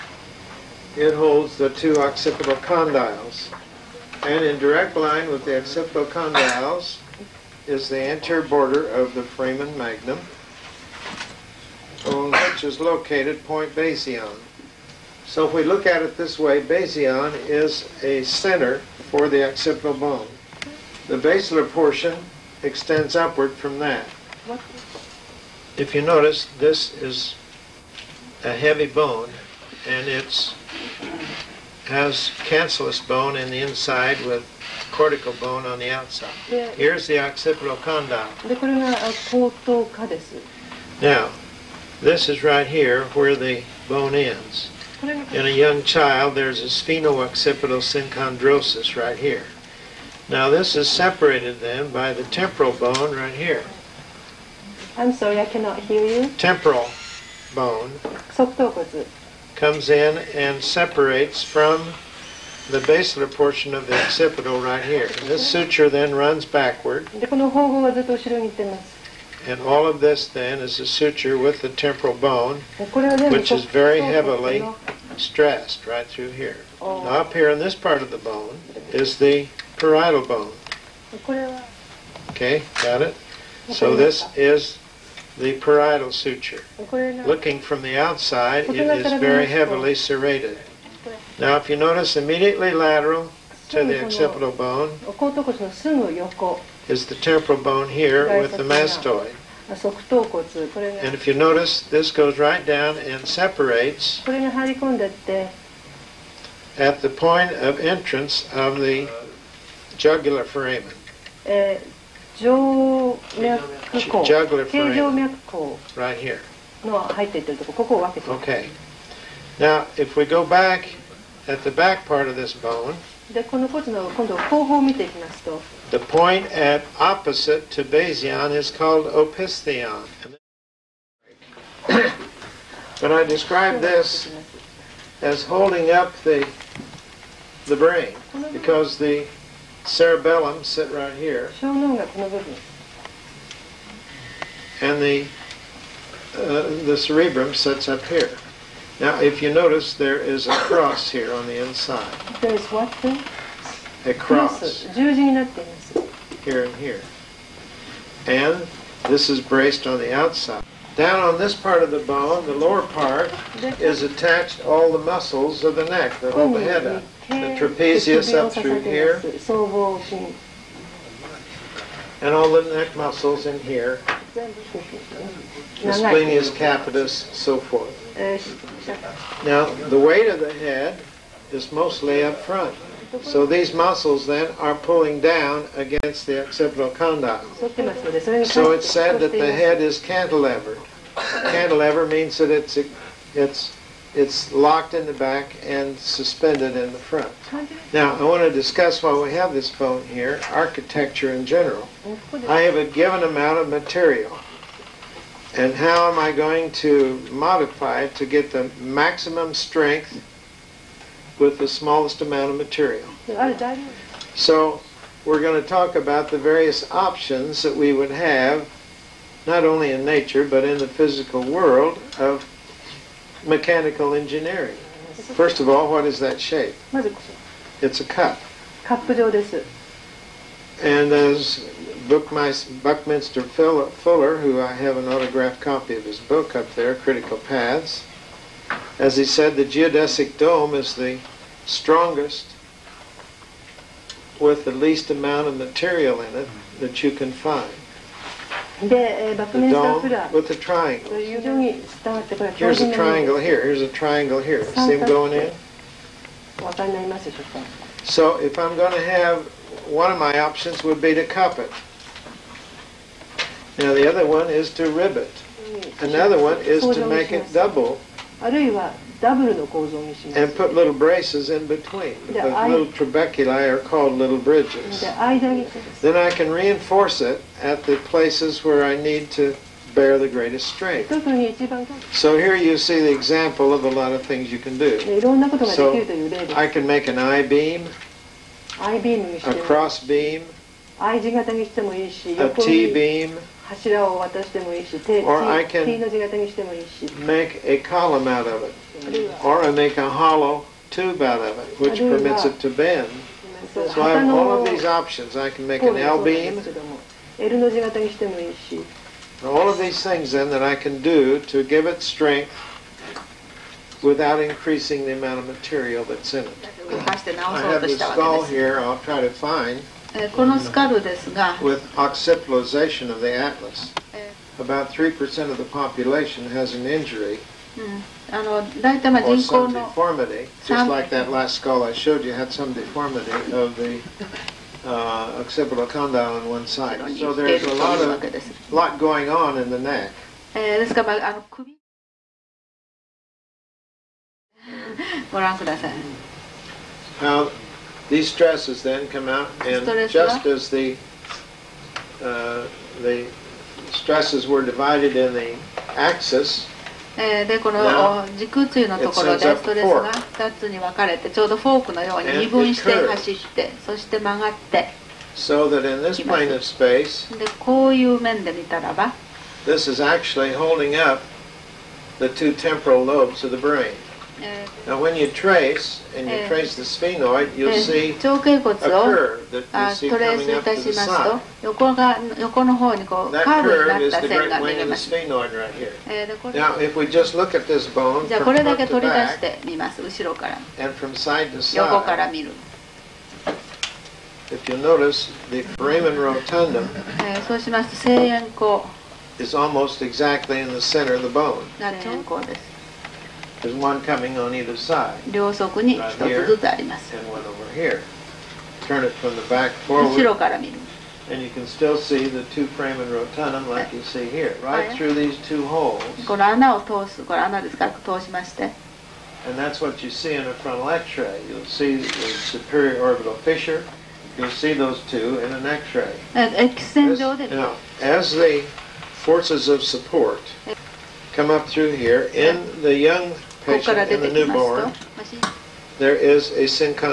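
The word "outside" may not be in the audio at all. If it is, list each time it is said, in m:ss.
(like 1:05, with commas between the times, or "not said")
0:35, 1:27, 2:40.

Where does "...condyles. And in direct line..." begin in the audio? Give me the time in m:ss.
0:02.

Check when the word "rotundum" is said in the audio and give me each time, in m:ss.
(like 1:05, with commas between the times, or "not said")
6:36, 6:53.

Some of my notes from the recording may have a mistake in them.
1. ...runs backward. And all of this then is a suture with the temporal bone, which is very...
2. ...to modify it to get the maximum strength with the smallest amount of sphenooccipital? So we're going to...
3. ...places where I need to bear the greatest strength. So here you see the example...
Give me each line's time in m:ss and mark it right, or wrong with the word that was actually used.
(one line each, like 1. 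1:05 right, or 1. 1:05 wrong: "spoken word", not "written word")
1. 1:06 right
2. 3:26 wrong: "material", not "sphenooccipital"
3. 4:38 right.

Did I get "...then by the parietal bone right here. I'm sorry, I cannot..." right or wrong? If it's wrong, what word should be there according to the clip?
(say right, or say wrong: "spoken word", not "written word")
wrong: "temporal", not "parietal".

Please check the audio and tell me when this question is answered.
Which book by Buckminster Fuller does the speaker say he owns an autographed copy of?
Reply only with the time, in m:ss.
3:56.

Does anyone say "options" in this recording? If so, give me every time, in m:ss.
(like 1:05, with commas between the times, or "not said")
3:36, 4:20, 5:04.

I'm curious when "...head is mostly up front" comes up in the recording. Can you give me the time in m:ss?
3:00.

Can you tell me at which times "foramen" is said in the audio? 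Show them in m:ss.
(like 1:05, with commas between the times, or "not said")
0:09, 1:50, 1:54, 6:35, 6:52.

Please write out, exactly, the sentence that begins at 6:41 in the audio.
声 円 弧 で す。 there's one coming on either side.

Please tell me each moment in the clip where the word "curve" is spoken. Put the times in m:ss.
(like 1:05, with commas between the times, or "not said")
6:18, 6:23.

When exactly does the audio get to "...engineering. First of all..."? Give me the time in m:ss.
3:44.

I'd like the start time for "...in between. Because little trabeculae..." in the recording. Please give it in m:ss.
4:31.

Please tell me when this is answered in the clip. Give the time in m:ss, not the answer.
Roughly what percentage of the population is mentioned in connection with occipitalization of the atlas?
5:24.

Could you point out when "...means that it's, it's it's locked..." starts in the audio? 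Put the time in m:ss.
3:12.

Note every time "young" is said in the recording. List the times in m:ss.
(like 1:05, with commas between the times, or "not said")
0:45, 7:12.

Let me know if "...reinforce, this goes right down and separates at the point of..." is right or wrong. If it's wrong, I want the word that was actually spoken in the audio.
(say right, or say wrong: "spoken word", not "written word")
wrong: "notice", not "reinforce".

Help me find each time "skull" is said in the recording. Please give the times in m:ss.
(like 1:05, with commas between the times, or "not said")
5:17, 5:31.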